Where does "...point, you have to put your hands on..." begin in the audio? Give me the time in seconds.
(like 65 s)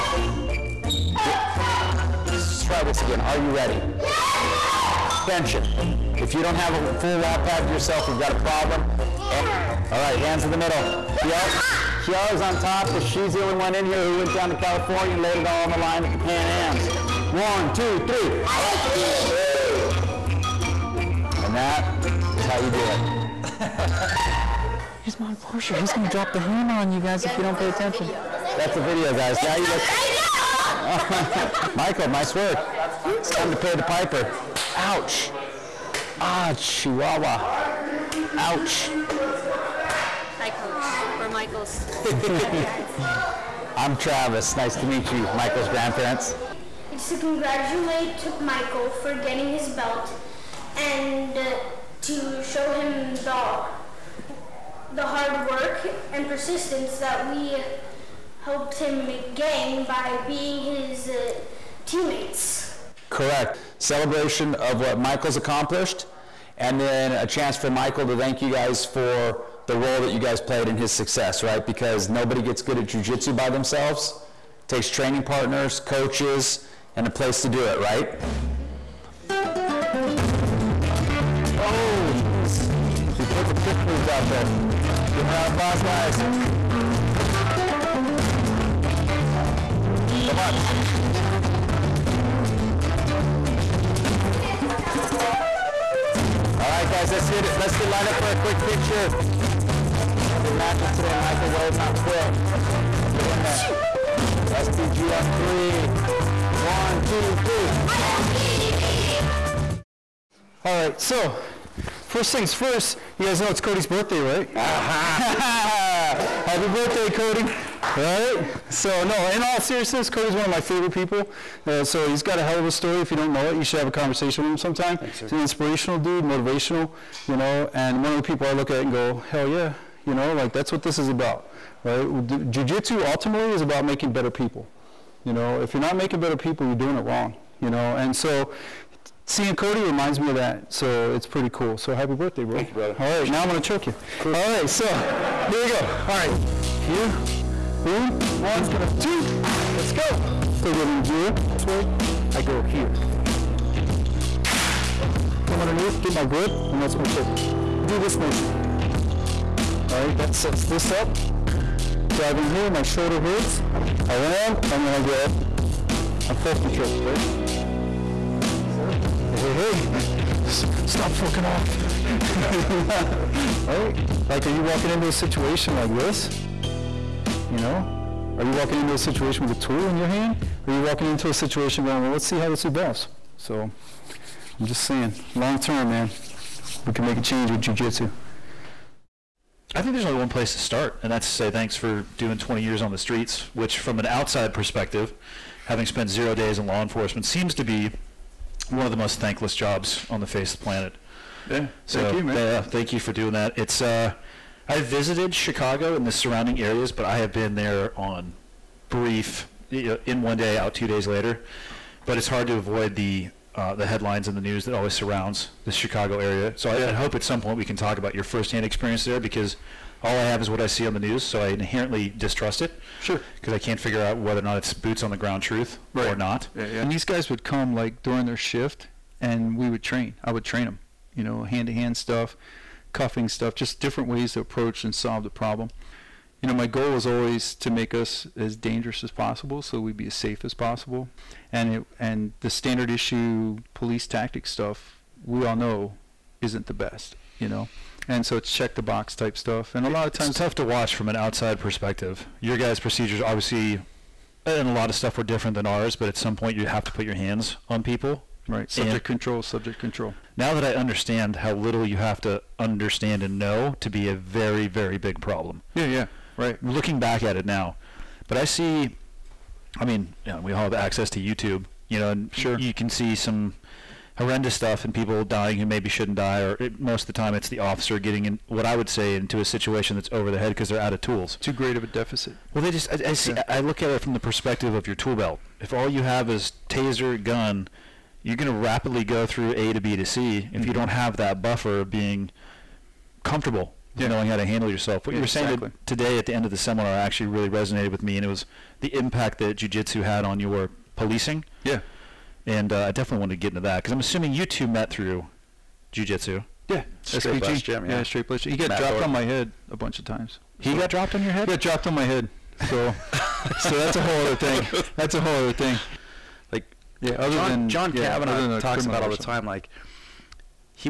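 256 s.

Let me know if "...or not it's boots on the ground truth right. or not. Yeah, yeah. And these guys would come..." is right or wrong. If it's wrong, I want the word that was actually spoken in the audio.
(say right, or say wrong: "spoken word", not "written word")
right.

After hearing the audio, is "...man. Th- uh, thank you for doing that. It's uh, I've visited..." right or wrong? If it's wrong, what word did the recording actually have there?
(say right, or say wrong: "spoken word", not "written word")
right.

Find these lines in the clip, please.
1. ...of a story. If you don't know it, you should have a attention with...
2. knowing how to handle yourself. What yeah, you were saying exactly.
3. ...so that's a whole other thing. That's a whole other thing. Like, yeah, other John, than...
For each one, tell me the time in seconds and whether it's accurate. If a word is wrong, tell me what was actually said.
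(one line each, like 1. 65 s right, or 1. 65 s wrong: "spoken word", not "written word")
1. 122 s wrong: "conversation", not "attention"
2. 294 s right
3. 313 s right.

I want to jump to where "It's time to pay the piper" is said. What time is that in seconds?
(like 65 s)
33 s.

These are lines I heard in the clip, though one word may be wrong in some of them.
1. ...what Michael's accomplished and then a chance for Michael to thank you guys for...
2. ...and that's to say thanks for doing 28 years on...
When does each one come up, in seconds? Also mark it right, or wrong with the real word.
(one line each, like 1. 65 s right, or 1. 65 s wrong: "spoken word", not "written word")
1. 64 s right
2. 191 s wrong: "20", not "28".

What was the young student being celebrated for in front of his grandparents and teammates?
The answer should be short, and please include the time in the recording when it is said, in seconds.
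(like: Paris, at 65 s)
his belt, at 49 s.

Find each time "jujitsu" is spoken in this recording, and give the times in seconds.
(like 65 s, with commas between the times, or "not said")
72 s, 187 s, 299 s, 305 s.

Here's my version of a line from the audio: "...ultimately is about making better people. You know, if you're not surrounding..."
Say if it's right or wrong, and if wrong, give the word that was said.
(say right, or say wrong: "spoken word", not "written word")
wrong: "making", not "surrounding".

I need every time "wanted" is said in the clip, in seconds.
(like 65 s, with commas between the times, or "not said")
303 s.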